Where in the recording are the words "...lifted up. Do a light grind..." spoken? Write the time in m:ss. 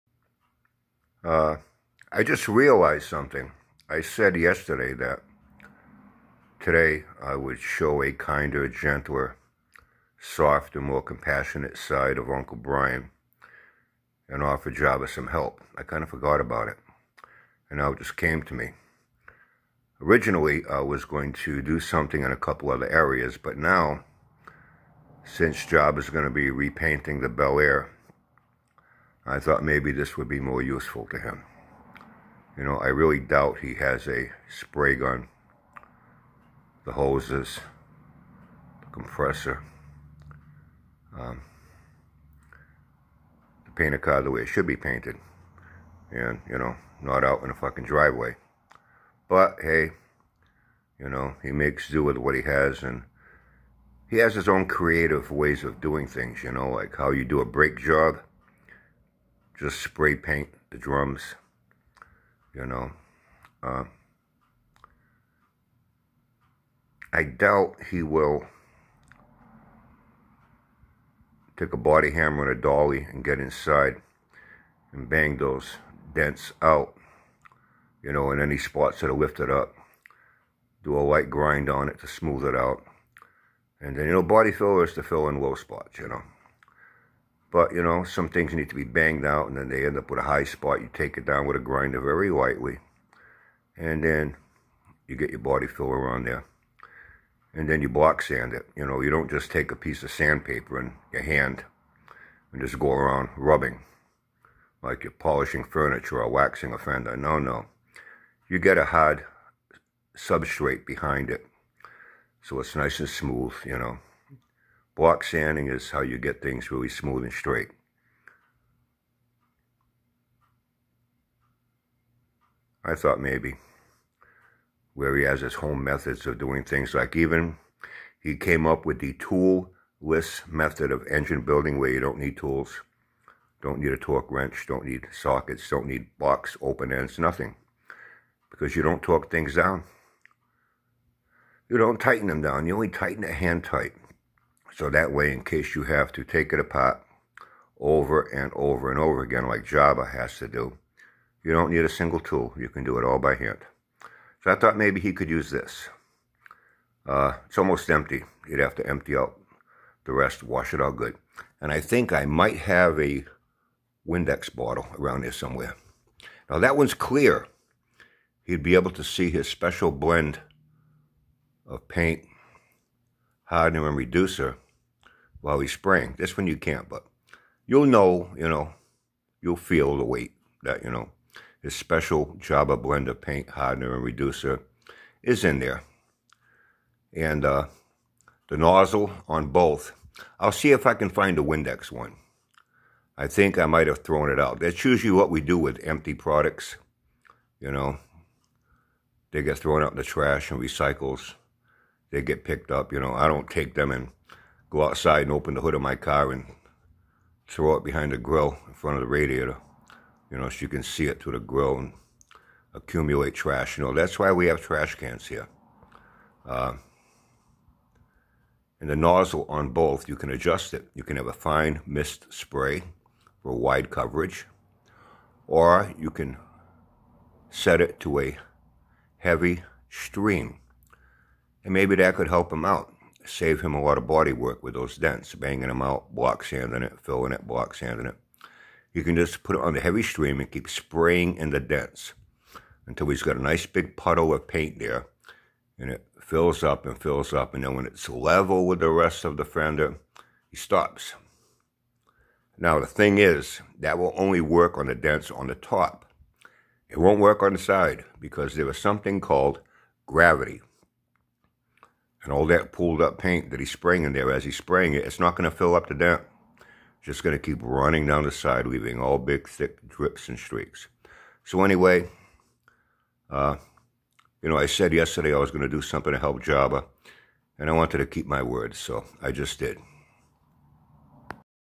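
1:19.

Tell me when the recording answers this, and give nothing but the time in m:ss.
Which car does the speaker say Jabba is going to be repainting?
0:27.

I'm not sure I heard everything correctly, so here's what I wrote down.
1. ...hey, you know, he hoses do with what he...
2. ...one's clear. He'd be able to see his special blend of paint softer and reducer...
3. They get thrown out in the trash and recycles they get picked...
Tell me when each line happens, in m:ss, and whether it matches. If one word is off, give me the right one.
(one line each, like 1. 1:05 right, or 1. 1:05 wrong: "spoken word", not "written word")
1. 0:49 wrong: "makes", not "hoses"
2. 2:46 wrong: "hardener", not "softer"
3. 3:19 right.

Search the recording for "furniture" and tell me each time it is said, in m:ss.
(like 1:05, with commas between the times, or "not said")
1:45.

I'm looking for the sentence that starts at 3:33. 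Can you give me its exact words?
You know, that's why we have trash cans here.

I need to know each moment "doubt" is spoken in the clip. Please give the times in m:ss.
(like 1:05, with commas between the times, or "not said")
0:33, 1:07.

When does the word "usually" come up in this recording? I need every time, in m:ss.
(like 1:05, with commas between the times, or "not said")
3:14.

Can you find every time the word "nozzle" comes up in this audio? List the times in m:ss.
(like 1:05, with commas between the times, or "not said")
3:08, 3:38.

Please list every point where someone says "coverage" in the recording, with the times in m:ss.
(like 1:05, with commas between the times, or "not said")
3:43.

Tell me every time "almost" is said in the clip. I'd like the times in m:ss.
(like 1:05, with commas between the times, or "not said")
2:37.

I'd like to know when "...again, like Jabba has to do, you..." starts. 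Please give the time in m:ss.
2:29.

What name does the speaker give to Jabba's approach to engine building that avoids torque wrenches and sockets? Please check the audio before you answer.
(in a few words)
toolless method.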